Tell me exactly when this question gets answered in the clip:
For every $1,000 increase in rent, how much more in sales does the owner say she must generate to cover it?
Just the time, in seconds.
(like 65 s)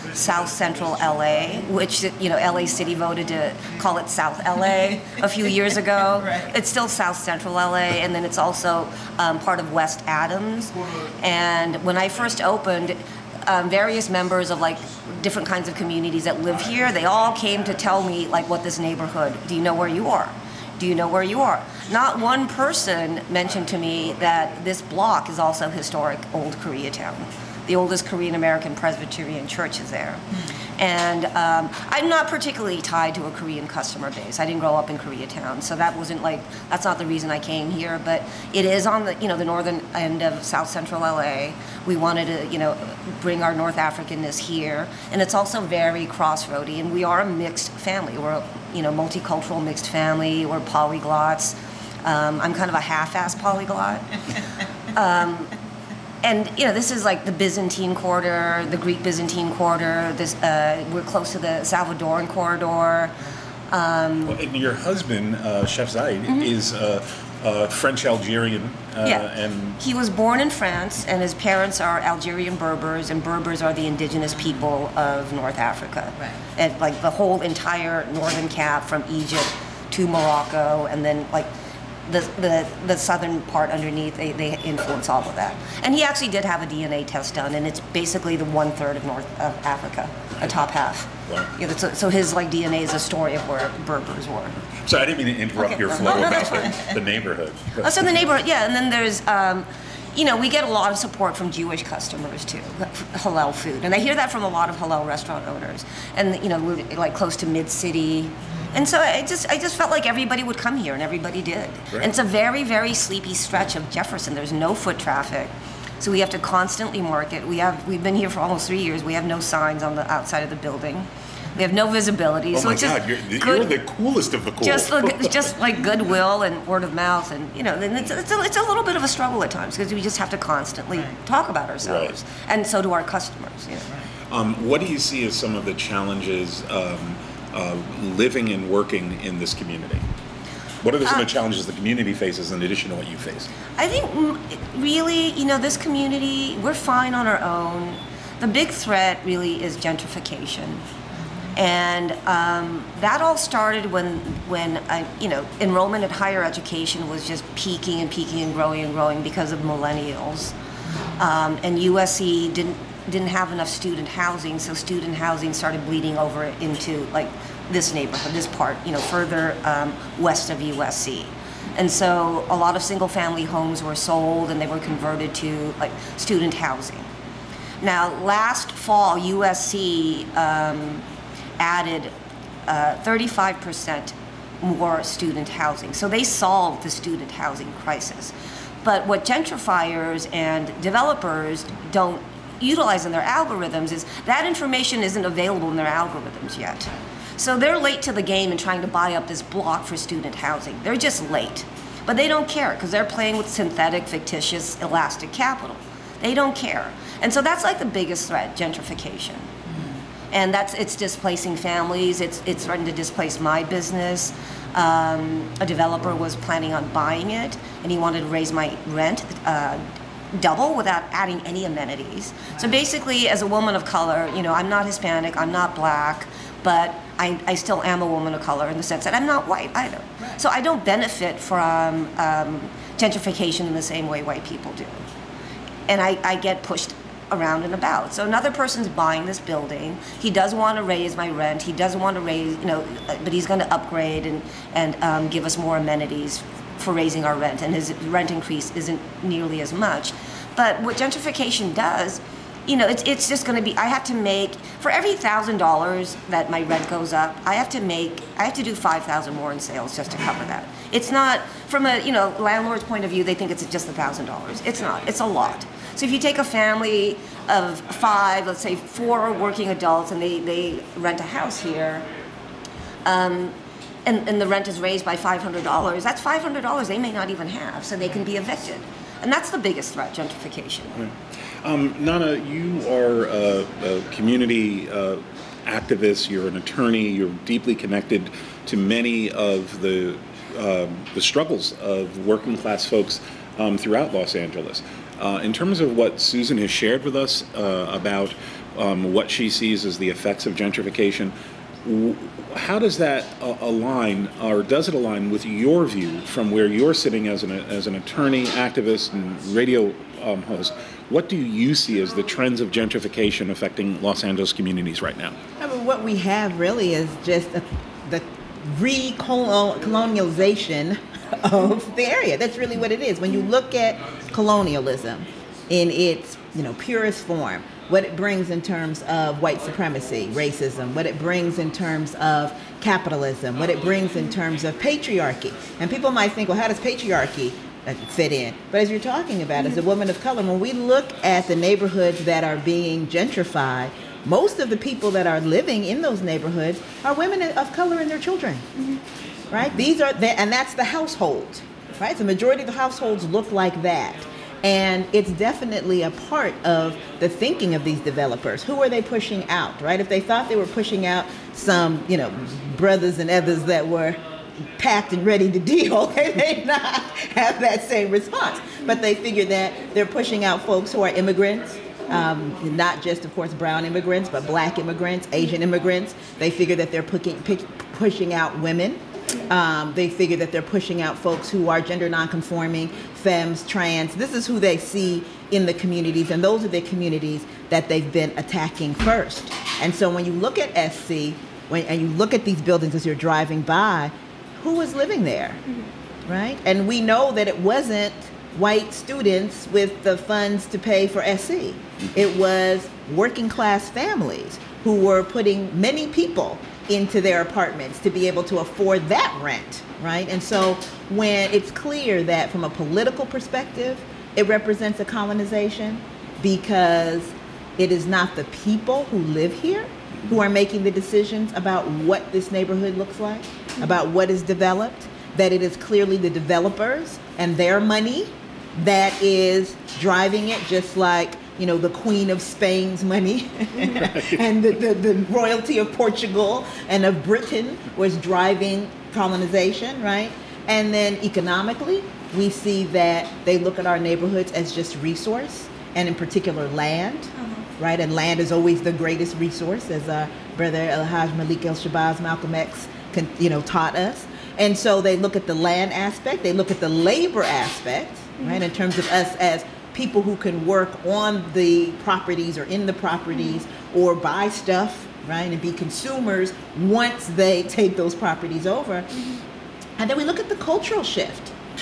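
258 s.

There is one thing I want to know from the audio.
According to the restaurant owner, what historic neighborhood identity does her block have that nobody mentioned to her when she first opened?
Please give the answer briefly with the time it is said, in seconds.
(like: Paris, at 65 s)
Old Koreatown, at 25 s.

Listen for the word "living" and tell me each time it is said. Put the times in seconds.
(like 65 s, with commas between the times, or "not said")
138 s, 345 s, 394 s.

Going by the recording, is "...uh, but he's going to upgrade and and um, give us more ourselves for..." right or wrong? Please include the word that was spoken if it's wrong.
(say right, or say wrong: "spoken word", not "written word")
wrong: "amenities", not "ourselves".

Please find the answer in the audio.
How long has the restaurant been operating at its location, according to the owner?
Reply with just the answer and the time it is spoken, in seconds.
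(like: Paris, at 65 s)
almost 3 years, at 118 s.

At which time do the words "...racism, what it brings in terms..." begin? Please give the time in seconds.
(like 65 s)
330 s.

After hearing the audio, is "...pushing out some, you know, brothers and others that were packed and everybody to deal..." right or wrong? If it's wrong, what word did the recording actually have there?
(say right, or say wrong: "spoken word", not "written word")
wrong: "ready", not "everybody".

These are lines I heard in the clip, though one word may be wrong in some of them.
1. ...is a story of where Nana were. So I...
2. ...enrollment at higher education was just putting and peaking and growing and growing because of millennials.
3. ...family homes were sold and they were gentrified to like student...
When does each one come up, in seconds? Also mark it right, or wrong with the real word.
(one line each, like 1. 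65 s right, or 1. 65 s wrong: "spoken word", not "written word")
1. 92 s wrong: "Berbers", not "Nana"
2. 155 s wrong: "peaking", not "putting"
3. 173 s wrong: "converted", not "gentrified".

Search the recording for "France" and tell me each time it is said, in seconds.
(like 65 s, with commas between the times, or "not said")
70 s.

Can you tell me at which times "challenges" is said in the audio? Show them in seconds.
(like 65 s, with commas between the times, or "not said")
135 s, 141 s.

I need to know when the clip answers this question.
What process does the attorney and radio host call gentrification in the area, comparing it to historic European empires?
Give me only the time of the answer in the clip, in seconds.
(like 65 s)
318 s.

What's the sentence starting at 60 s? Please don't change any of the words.
This uh, we're close to the Salvadoran corridor.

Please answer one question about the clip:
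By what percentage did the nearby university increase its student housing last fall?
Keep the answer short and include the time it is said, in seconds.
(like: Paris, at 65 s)
35%, at 182 s.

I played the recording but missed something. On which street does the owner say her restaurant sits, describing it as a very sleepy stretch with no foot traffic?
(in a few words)
Jefferson.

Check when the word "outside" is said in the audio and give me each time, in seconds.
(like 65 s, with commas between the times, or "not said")
120 s.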